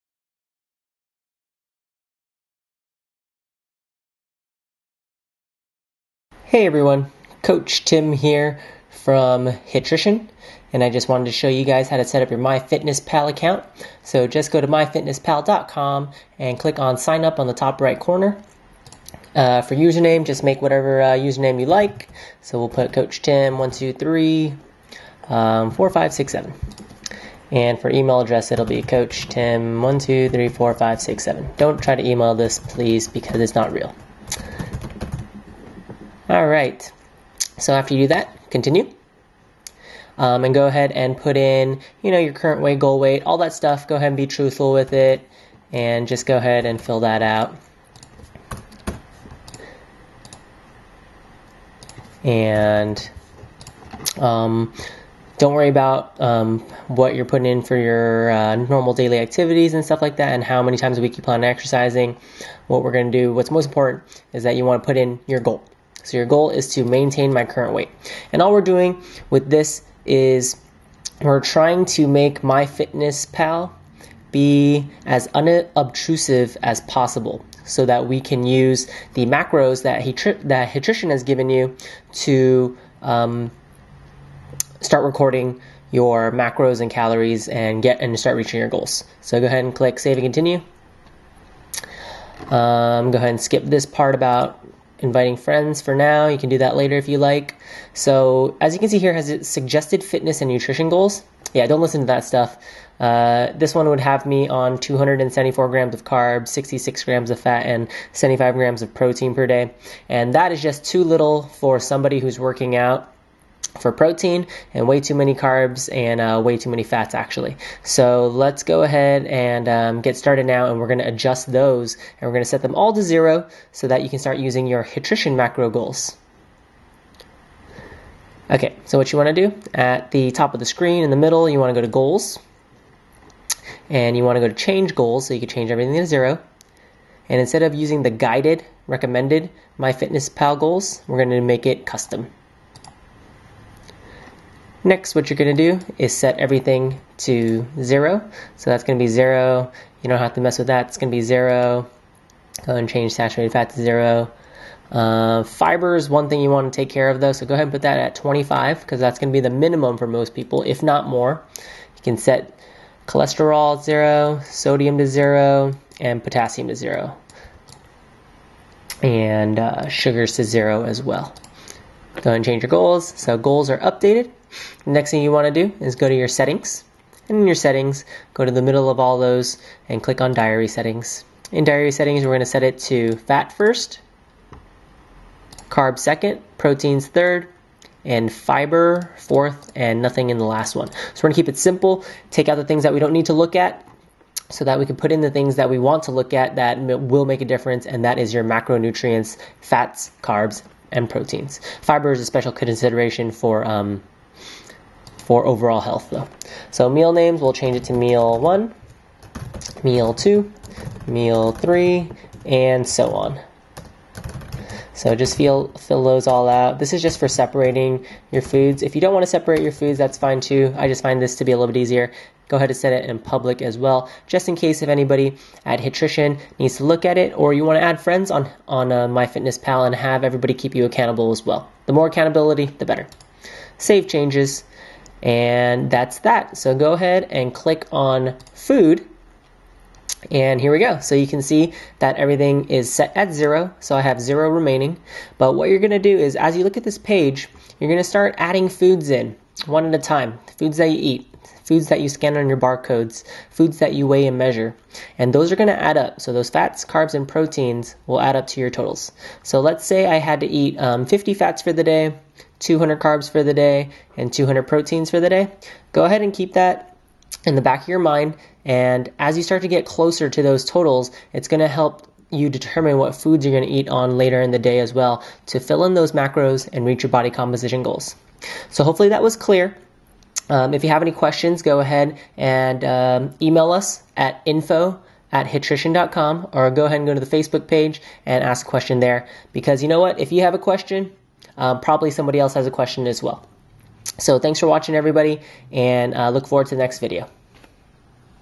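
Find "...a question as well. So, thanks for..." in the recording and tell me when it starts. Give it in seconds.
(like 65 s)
292 s.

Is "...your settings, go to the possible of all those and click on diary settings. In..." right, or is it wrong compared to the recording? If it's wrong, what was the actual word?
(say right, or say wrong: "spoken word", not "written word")
wrong: "middle", not "possible".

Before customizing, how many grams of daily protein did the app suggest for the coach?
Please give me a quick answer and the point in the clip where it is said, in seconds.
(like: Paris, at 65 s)
75 grams, at 108 s.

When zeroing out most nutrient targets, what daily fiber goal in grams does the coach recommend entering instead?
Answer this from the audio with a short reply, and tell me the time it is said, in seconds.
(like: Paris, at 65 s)
25, at 158 s.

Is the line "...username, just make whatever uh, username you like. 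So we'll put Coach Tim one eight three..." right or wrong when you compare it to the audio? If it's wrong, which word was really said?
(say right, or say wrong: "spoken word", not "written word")
wrong: "two", not "eight".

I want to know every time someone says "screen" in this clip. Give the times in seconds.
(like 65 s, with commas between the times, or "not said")
130 s.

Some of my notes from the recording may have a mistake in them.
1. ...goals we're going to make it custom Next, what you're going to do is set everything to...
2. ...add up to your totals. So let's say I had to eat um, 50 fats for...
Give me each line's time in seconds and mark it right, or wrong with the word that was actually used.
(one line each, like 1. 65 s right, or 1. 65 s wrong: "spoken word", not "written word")
1. 140 s right
2. 258 s right.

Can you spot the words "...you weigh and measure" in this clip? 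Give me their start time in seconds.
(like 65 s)
253 s.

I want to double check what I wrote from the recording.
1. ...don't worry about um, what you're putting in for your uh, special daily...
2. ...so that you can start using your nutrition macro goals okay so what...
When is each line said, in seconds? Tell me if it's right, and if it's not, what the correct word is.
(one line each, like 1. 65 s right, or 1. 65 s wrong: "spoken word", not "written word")
1. 55 s wrong: "normal", not "special"
2. 123 s right.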